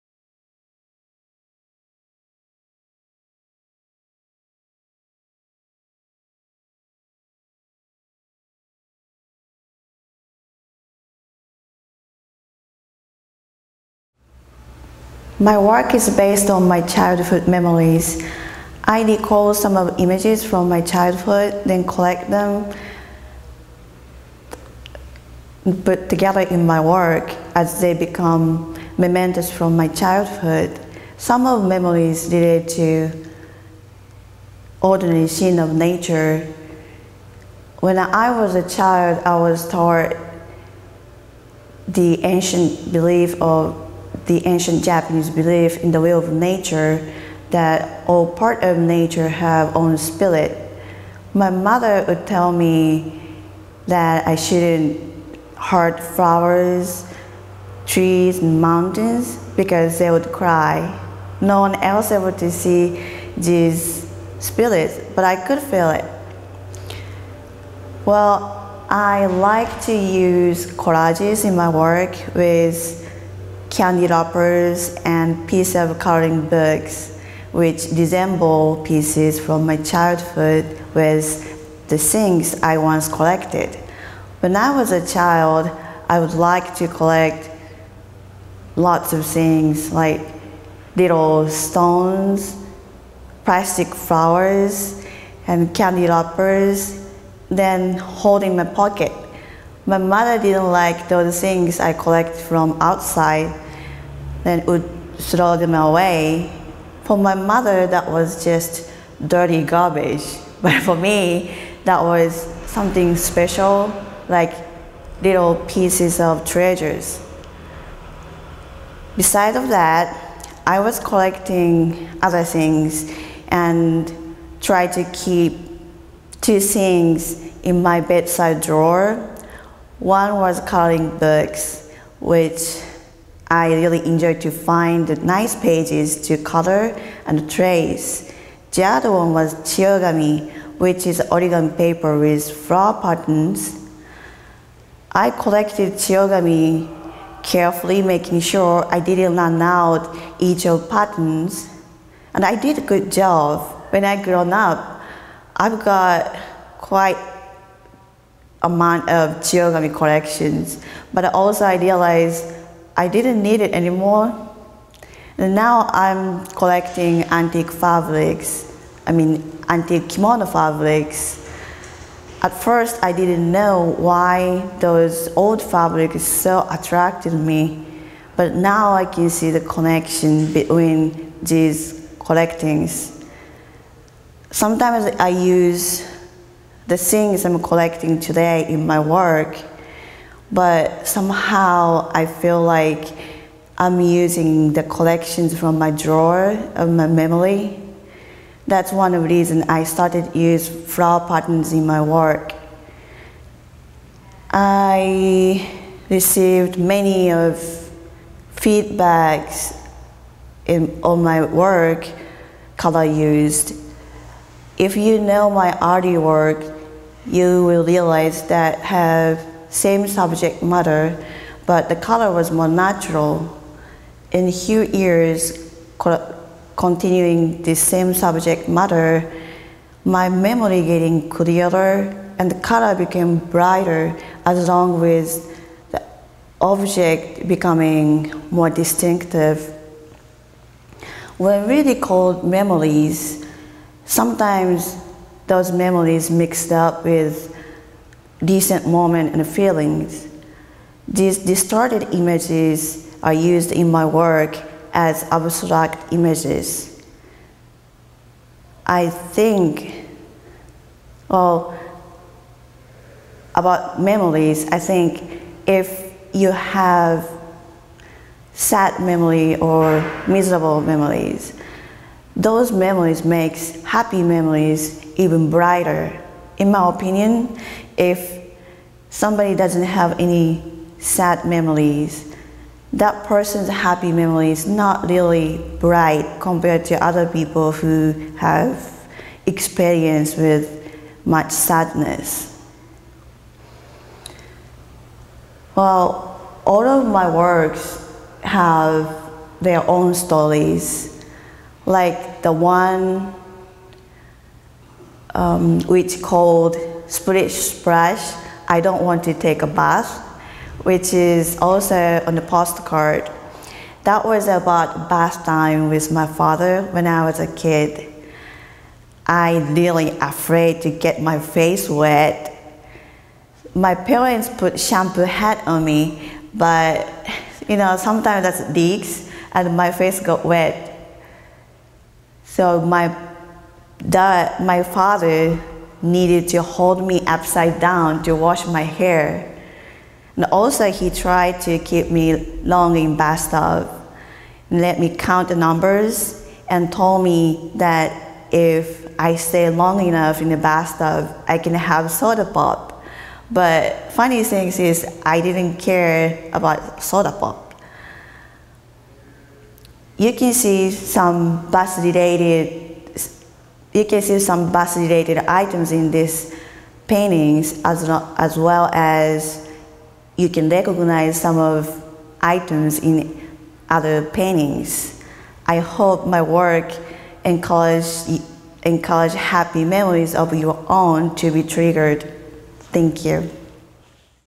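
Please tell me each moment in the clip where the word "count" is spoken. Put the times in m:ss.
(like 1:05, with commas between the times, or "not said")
5:45.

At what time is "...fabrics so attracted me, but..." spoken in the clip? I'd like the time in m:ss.
2:55.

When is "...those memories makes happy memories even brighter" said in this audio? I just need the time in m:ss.
4:32.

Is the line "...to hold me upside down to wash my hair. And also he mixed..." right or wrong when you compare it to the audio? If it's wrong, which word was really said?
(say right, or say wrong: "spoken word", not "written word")
wrong: "tried", not "mixed".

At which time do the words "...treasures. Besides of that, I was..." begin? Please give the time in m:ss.
1:56.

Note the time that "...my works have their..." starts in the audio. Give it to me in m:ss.
4:57.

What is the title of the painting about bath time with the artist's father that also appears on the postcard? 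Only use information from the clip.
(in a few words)
Splish Splash, I don't want to take a bath.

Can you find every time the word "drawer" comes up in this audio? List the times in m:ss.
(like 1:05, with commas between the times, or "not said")
2:08, 3:15.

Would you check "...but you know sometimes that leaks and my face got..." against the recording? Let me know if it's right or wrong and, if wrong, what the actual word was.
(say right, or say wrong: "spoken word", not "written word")
right.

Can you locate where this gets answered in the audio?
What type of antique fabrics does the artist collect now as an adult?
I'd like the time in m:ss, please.
2:50.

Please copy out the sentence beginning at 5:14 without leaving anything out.
That was about bath time with my father when I was a kid.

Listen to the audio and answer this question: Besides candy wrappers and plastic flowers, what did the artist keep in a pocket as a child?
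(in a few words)
little stones.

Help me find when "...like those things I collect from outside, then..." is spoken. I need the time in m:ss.
1:40.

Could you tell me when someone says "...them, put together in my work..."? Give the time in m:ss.
0:22.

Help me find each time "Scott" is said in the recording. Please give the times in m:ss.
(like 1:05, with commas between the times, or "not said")
not said.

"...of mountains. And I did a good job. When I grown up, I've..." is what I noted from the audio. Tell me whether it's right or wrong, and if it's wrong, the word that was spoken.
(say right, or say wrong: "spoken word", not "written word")
wrong: "patterns", not "mountains".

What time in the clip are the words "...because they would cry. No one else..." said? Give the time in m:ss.
0:59.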